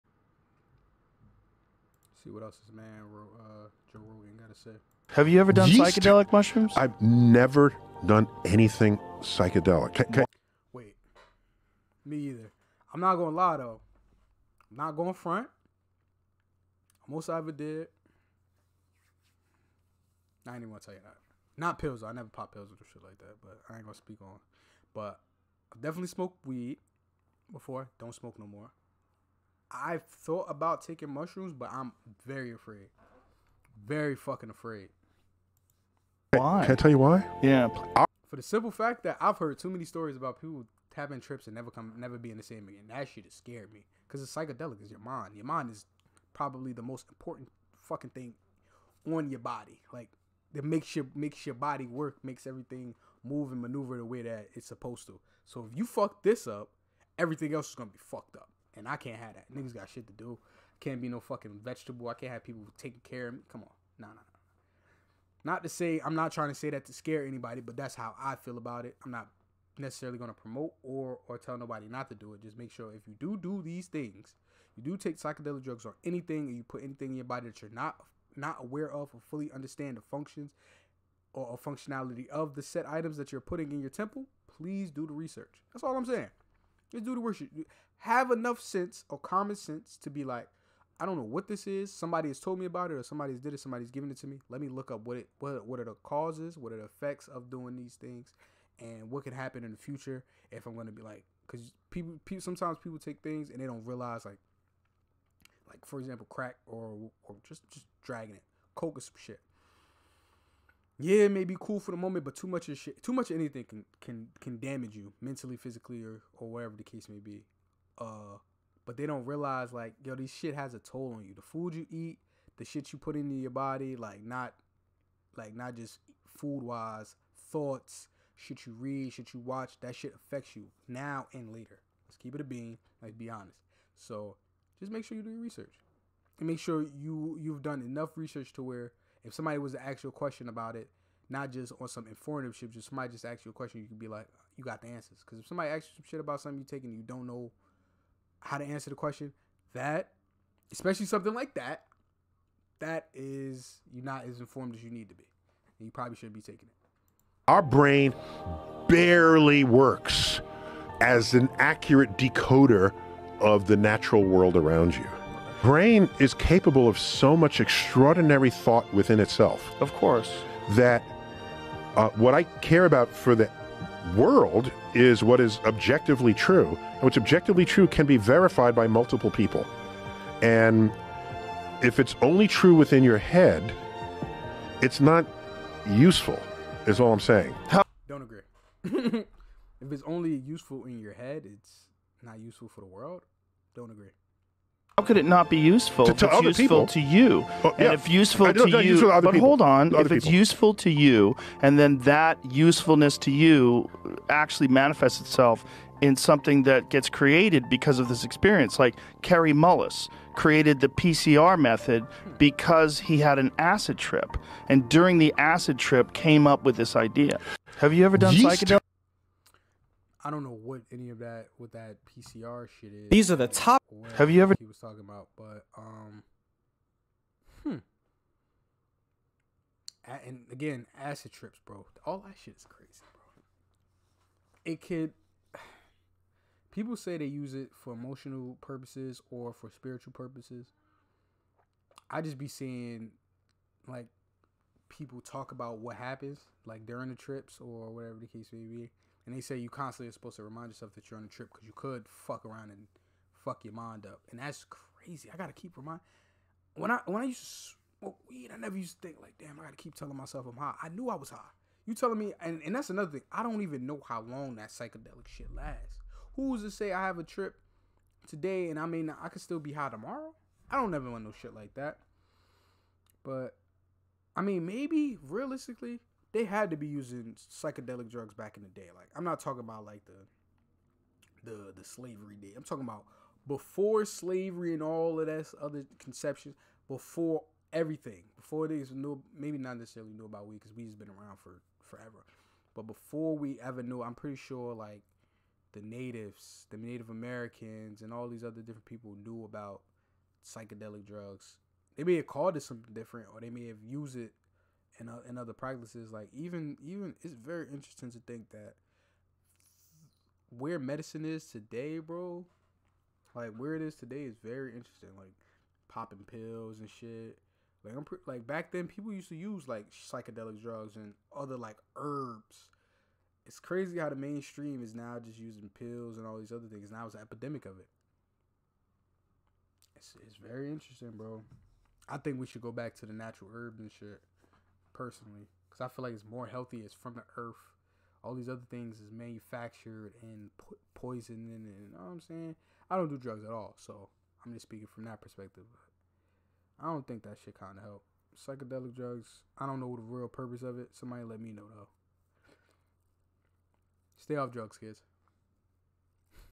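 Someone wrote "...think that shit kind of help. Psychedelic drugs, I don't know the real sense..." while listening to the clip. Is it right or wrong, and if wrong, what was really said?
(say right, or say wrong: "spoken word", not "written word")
wrong: "purpose", not "sense".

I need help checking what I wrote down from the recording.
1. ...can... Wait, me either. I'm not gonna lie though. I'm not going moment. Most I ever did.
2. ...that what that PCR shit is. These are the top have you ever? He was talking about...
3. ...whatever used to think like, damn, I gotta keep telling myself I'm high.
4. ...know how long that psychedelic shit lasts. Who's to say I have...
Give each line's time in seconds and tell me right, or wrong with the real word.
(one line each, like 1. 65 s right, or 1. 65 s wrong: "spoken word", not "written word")
1. 10 s wrong: "front", not "moment"
2. 221 s right
3. 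258 s wrong: "never", not "whatever"
4. 263 s right.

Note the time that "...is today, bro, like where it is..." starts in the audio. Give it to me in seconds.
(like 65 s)
311 s.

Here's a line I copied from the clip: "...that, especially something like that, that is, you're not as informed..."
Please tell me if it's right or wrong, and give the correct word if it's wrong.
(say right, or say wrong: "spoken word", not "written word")
right.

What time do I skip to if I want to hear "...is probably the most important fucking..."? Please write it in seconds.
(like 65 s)
45 s.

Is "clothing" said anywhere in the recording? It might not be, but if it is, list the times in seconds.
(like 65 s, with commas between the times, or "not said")
not said.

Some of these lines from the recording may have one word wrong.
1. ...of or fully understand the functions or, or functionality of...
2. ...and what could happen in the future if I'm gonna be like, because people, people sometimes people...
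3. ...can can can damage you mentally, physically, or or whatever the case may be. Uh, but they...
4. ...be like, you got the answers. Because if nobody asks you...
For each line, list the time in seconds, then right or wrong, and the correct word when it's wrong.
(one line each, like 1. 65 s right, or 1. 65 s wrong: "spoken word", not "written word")
1. 78 s right
2. 98 s right
3. 113 s right
4. 143 s wrong: "somebody", not "nobody".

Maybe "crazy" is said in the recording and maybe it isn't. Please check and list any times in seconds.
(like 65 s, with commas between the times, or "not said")
232 s, 254 s, 323 s.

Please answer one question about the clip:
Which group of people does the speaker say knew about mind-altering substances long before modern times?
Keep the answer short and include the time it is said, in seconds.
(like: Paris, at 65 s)
Native Americans, at 296 s.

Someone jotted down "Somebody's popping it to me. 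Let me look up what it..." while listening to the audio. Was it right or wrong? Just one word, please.
wrong.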